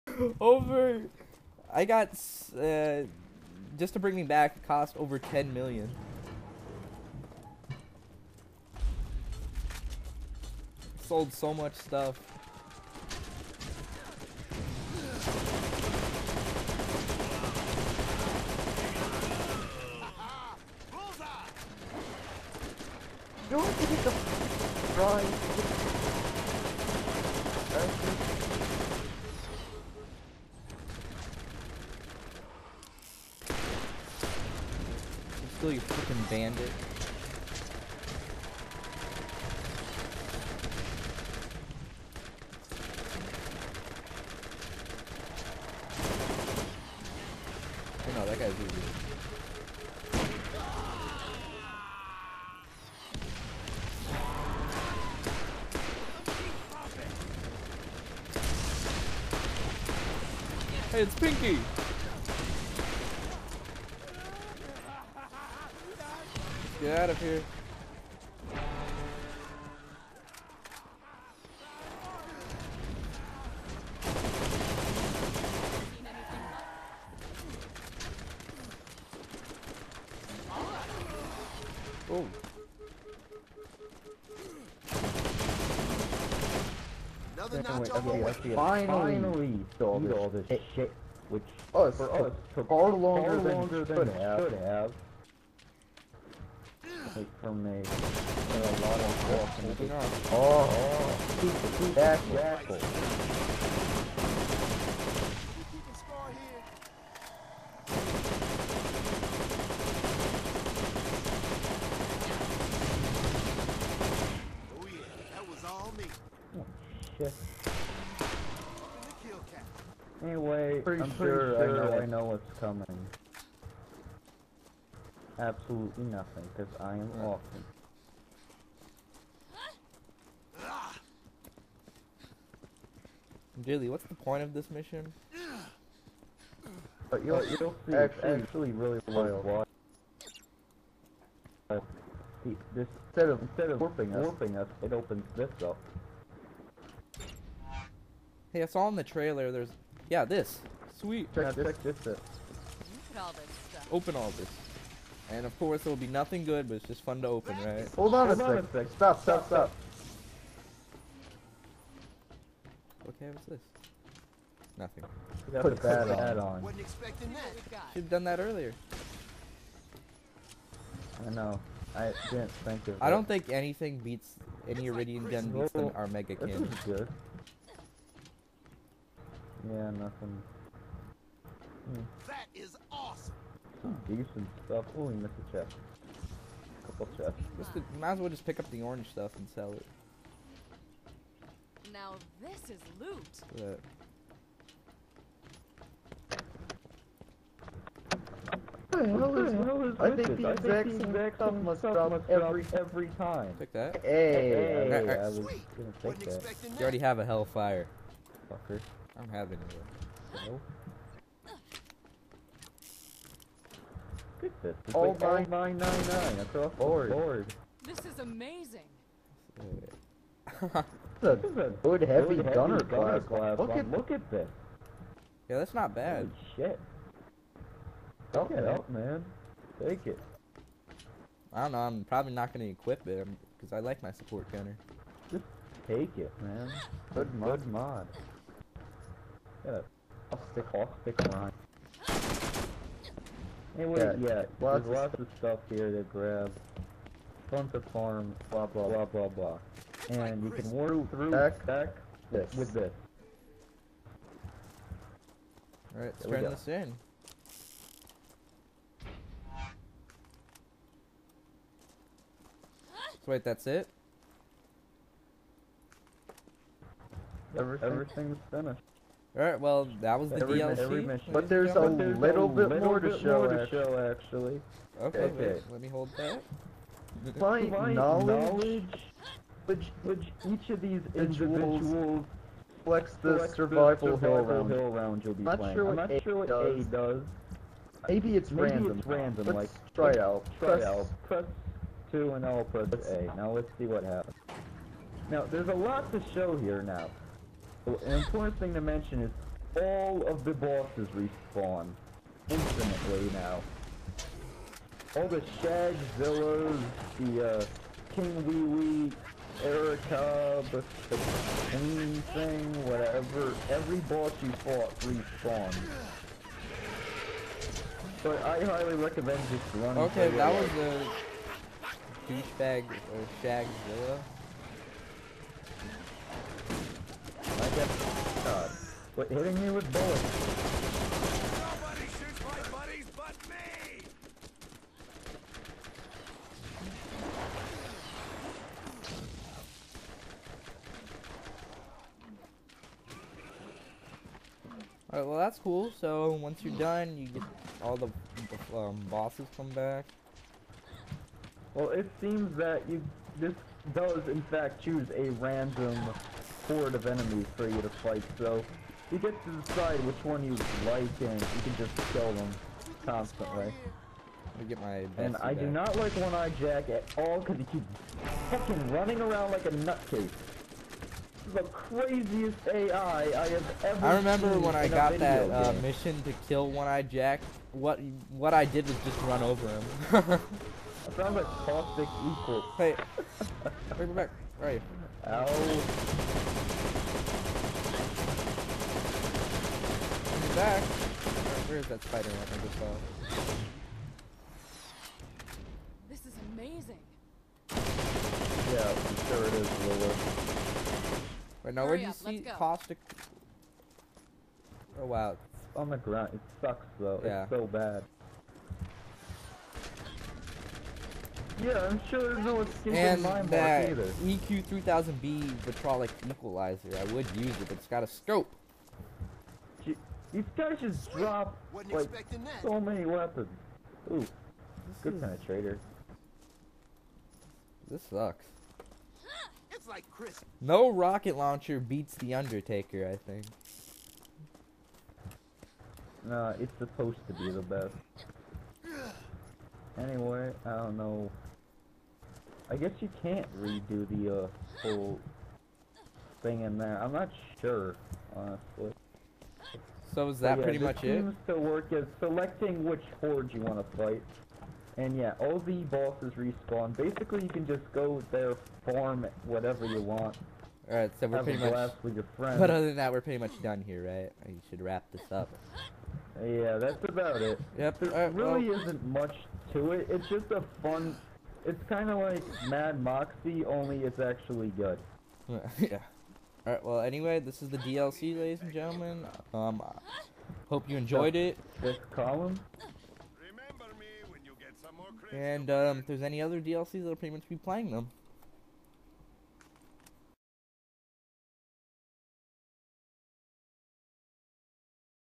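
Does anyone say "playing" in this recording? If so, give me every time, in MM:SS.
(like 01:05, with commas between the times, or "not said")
04:45, 08:07.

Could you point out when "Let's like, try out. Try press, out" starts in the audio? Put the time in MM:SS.
04:49.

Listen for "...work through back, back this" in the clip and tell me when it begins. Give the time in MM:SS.
04:10.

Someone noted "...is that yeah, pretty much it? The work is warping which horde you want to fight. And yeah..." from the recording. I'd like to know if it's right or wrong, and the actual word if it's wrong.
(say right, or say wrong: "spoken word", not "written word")
wrong: "selecting", not "warping".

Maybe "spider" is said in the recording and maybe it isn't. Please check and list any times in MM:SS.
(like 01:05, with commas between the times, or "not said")
06:32.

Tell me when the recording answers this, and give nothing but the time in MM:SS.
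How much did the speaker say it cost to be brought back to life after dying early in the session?
00:04.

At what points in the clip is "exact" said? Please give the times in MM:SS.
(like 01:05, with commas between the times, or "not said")
03:20.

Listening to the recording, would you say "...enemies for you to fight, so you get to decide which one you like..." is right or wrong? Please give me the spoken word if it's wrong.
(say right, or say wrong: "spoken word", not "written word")
right.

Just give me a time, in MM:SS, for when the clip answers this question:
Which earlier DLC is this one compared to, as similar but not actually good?
07:52.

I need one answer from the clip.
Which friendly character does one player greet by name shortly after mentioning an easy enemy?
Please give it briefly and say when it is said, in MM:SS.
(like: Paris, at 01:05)
Pinky, at 01:01.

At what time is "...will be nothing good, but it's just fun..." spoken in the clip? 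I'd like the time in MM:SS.
02:35.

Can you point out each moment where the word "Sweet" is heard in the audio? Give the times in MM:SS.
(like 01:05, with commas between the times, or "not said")
02:30, 03:25, 07:01.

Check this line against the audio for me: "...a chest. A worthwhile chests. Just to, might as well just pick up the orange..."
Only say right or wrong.
wrong.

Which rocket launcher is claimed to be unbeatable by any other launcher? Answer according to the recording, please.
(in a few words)
Undertaker.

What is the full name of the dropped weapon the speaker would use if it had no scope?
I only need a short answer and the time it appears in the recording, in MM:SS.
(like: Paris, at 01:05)
EQ 3000B Vitrolic Equalizer, at 06:54.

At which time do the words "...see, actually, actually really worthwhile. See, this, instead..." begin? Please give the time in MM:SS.
02:17.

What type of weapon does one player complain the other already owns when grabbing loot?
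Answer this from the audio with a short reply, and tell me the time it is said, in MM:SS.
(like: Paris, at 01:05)
hellfire, at 03:27.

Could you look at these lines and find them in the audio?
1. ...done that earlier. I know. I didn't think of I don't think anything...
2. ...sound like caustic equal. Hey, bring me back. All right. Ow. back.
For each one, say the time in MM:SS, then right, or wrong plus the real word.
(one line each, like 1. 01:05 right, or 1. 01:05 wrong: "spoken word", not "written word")
1. 02:48 right
2. 06:21 right.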